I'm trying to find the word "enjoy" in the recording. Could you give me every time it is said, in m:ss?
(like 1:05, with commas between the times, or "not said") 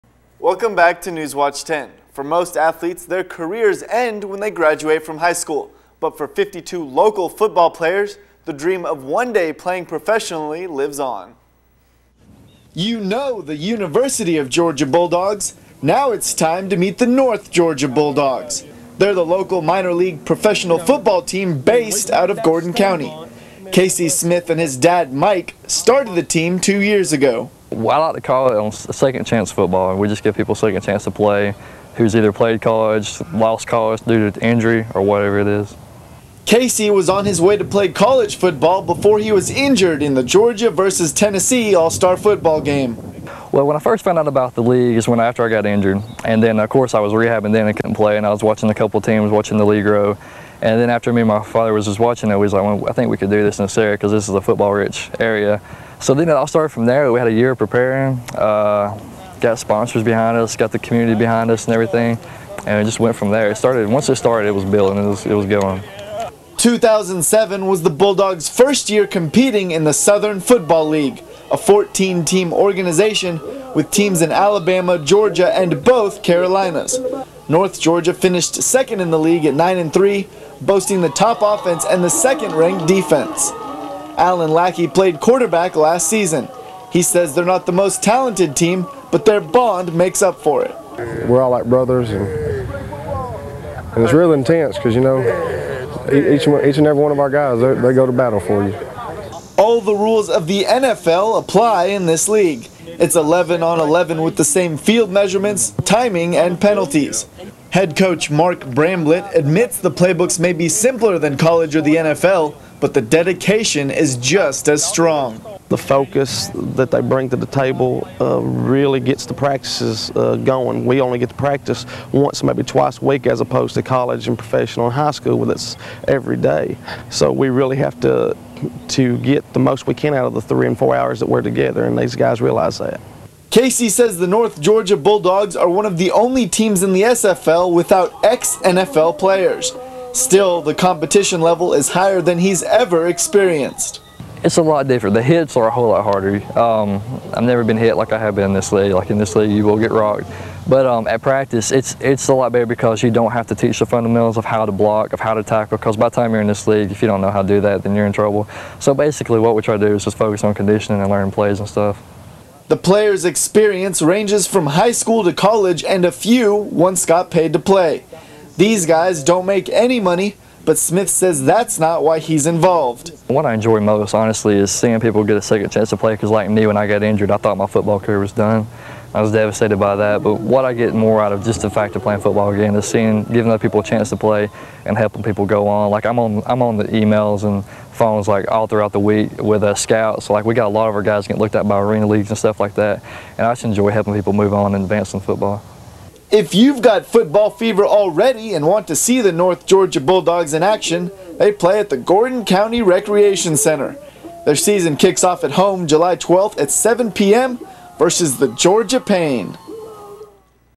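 2:53, 3:13.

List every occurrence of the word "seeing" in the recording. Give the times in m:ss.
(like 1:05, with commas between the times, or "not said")
2:54, 3:02.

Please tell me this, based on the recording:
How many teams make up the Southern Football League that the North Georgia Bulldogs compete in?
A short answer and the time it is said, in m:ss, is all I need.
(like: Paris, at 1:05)
14, at 1:11.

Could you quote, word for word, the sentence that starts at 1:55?
The focus that they bring to the table uh, really gets the practices uh, going.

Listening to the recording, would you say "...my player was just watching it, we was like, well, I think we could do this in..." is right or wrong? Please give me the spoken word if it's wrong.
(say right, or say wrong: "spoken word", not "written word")
wrong: "father", not "player".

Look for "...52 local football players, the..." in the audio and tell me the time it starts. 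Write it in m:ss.
0:06.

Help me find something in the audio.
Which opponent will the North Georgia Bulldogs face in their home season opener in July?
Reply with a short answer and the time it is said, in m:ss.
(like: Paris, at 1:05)
Georgia Pain, at 3:28.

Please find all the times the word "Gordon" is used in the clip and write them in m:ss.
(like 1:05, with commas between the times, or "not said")
0:22, 3:21.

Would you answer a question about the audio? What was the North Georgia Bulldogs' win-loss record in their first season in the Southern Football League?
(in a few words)
9-3.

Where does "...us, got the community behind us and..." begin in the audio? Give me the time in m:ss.
1:00.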